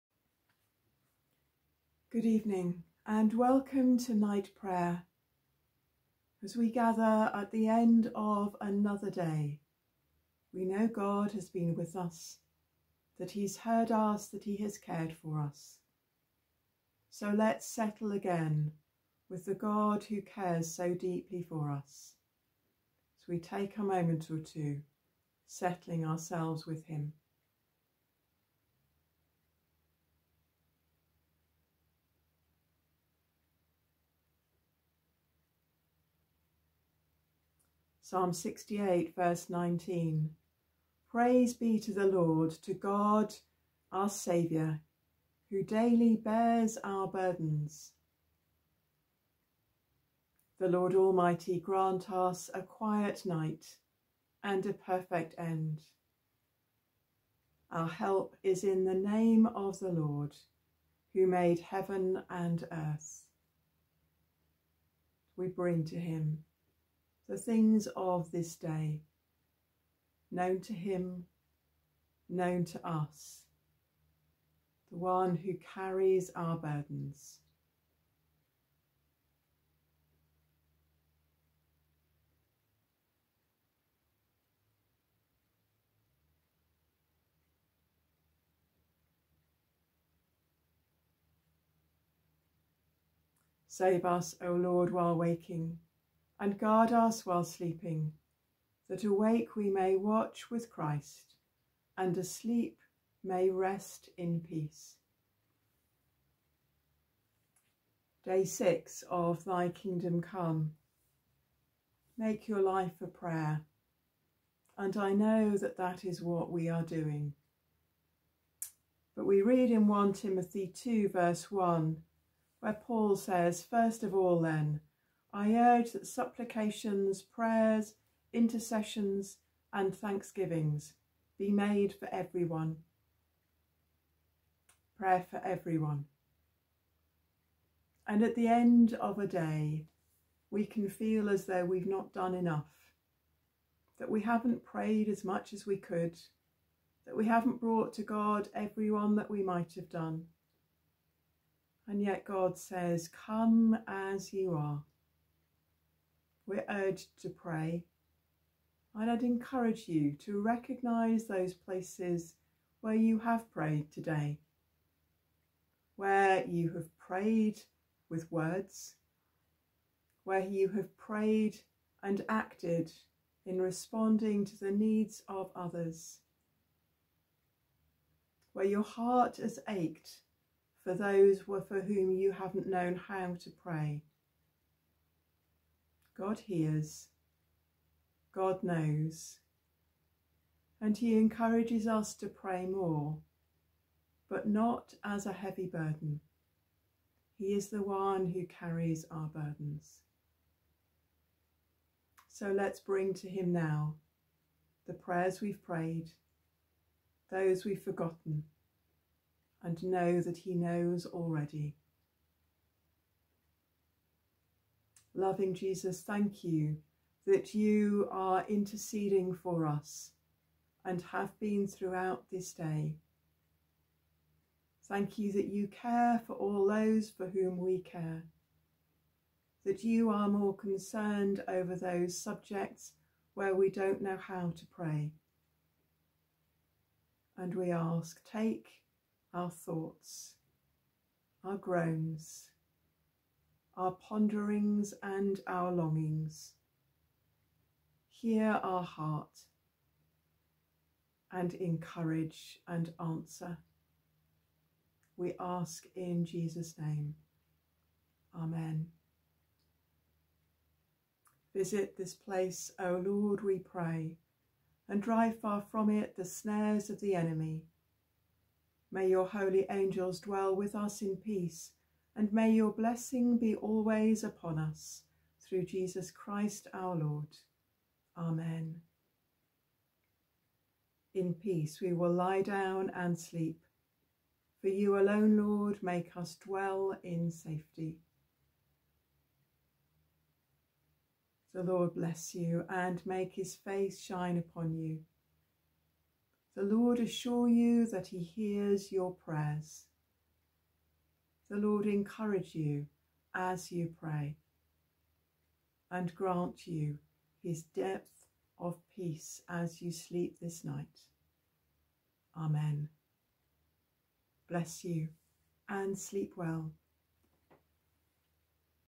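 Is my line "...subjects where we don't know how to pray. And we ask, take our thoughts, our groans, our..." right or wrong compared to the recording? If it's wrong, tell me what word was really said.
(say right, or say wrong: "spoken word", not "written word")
right.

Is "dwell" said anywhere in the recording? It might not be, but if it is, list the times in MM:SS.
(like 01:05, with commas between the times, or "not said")
04:30, 04:46.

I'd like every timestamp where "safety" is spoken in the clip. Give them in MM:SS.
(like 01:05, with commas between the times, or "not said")
04:47.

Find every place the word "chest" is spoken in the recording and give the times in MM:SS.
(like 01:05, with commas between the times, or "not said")
not said.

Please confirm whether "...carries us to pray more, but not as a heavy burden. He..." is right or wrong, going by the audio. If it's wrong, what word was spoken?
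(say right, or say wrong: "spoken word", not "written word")
wrong: "encourages", not "carries".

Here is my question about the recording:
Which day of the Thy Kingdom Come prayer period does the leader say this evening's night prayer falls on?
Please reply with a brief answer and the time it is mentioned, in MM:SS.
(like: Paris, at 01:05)
Day 6, at 01:48.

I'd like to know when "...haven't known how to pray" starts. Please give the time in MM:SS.
03:02.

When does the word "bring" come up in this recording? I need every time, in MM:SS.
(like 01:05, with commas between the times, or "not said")
01:05, 03:22.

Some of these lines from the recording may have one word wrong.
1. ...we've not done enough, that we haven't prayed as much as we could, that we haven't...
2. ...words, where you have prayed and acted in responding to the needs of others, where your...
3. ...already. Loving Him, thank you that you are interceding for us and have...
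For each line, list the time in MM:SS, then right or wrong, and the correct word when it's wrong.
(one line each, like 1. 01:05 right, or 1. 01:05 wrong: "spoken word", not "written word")
1. 02:21 right
2. 02:48 right
3. 03:31 wrong: "Jesus", not "Him".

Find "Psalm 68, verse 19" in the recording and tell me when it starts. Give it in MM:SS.
00:38.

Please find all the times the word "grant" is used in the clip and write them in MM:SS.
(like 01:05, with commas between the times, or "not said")
00:51, 05:06.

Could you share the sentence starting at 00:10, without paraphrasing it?
We know God has been with us, that he's heard us, that he has cared for us.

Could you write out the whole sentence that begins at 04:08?
Hear our heart and encourage and answer.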